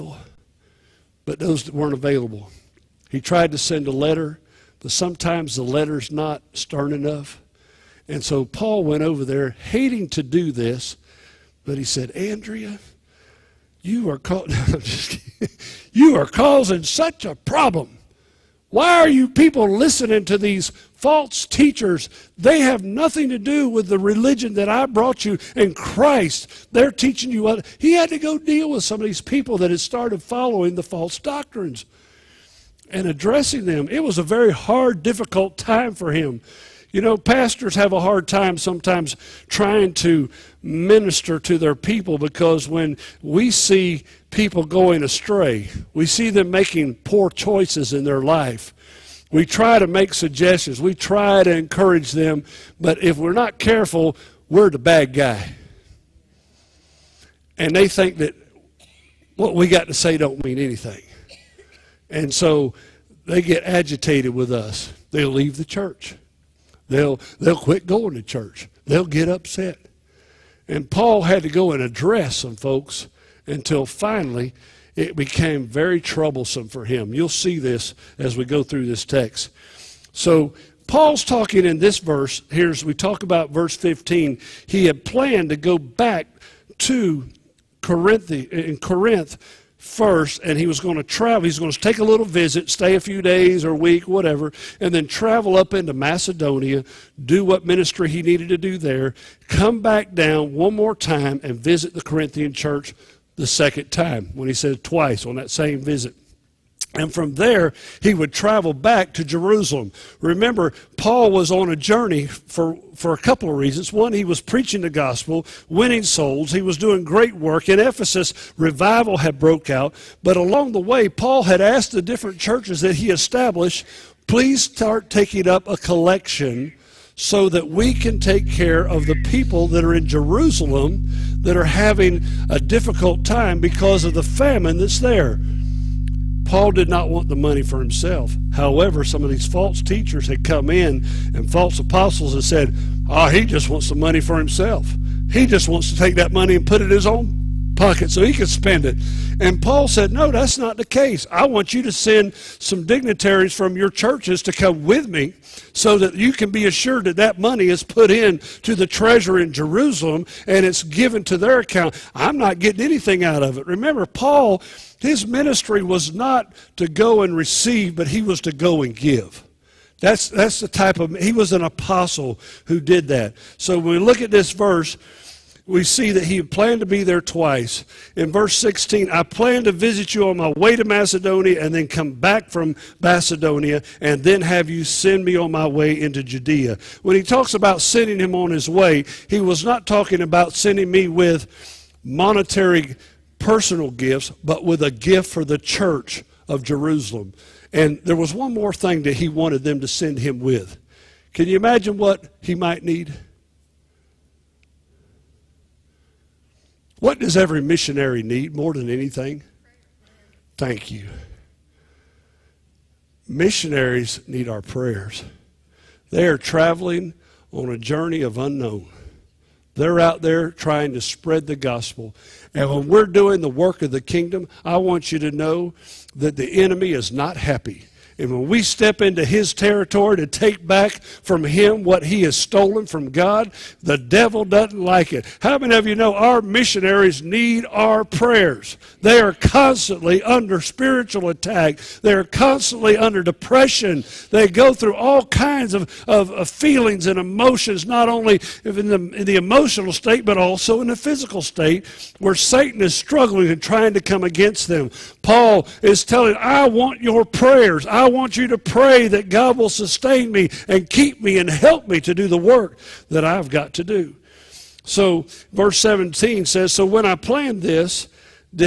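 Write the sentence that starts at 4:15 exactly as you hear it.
Paul is telling, I want your prayers.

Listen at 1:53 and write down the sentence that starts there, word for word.
One, he was preaching the gospel, winning souls.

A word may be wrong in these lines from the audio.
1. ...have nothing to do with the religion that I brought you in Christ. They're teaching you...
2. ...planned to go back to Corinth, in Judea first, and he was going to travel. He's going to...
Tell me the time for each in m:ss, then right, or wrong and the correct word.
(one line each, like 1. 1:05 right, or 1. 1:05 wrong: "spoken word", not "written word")
1. 0:22 right
2. 1:25 wrong: "Corinth", not "Judea".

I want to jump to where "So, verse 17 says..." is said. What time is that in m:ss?
4:24.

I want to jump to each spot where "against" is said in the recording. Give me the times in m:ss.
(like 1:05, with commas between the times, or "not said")
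4:14.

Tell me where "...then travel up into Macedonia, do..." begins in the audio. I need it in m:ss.
1:34.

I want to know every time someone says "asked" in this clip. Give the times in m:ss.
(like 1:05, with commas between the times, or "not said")
2:01.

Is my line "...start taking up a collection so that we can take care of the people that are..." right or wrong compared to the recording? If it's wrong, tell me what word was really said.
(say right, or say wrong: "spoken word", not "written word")
right.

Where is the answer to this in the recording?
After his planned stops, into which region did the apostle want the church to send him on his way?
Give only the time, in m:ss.
3:06.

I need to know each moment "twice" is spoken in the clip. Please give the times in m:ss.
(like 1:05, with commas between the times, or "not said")
1:44, 2:57.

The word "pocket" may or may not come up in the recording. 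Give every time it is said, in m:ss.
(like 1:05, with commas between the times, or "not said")
2:27.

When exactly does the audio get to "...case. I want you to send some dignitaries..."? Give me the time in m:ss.
2:30.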